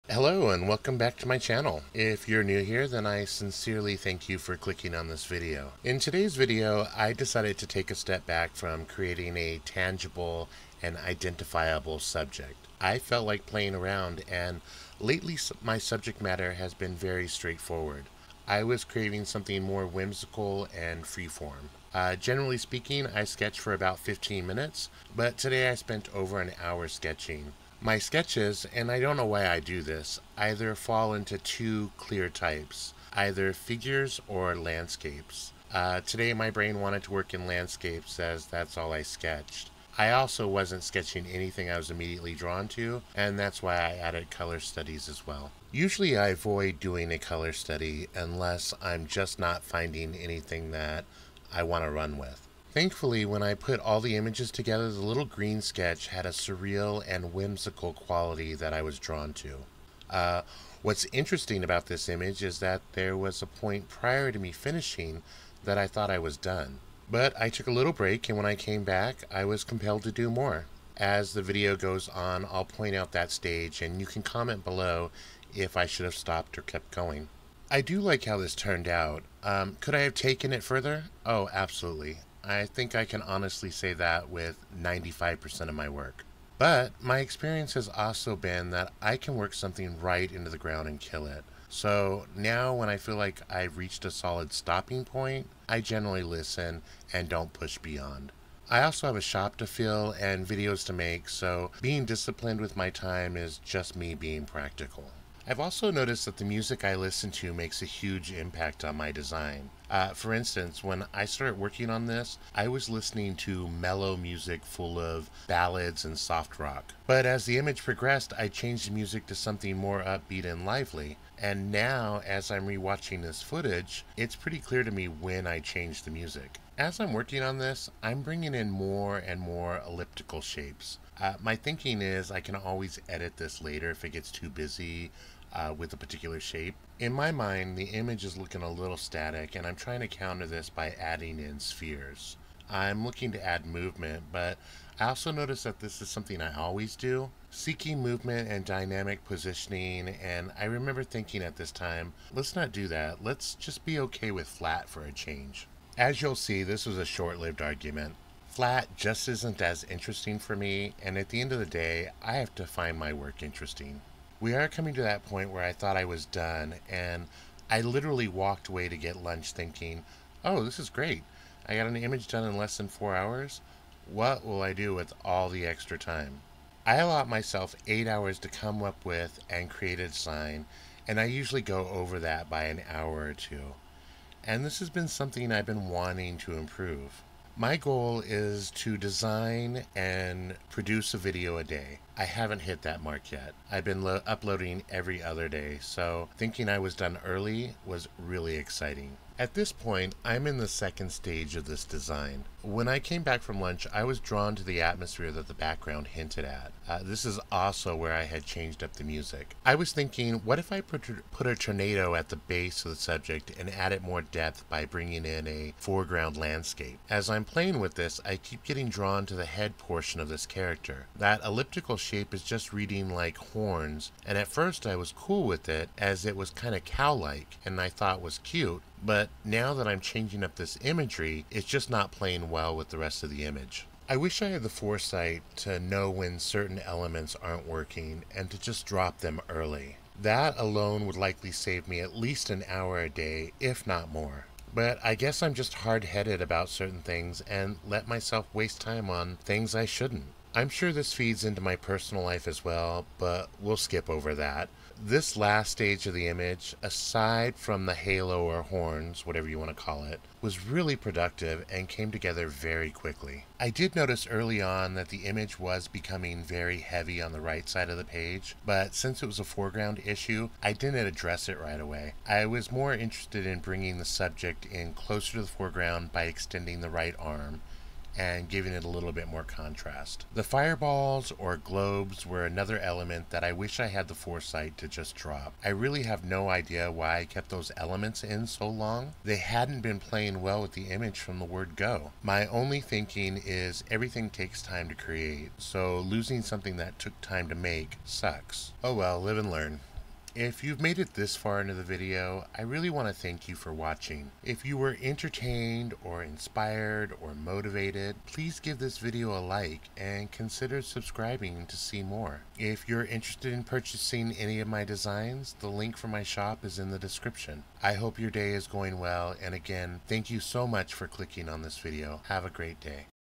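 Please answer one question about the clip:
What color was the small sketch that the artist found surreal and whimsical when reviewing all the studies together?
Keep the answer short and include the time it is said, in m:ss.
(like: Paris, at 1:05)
green, at 0:55.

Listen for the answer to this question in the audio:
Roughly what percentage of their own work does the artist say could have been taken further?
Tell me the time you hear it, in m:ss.
1:24.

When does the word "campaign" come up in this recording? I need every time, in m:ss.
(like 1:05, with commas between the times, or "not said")
not said.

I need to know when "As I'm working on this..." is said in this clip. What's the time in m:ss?
2:06.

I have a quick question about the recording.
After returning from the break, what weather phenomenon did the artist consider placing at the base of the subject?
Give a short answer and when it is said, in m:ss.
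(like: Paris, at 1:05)
tornado, at 3:31.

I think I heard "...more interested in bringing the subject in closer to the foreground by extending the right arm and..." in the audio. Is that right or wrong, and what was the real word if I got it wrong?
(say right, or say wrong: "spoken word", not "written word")
right.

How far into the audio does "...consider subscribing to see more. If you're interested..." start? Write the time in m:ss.
5:10.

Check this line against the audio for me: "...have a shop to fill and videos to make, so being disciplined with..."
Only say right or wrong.
right.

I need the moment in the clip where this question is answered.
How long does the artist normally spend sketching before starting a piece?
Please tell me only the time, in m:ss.
0:23.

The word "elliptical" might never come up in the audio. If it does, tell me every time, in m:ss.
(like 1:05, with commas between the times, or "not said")
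2:09, 3:41.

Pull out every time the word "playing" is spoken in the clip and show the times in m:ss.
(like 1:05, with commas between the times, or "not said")
0:13, 3:37, 3:52, 4:49.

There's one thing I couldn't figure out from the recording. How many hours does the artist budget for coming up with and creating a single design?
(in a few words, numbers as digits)
8.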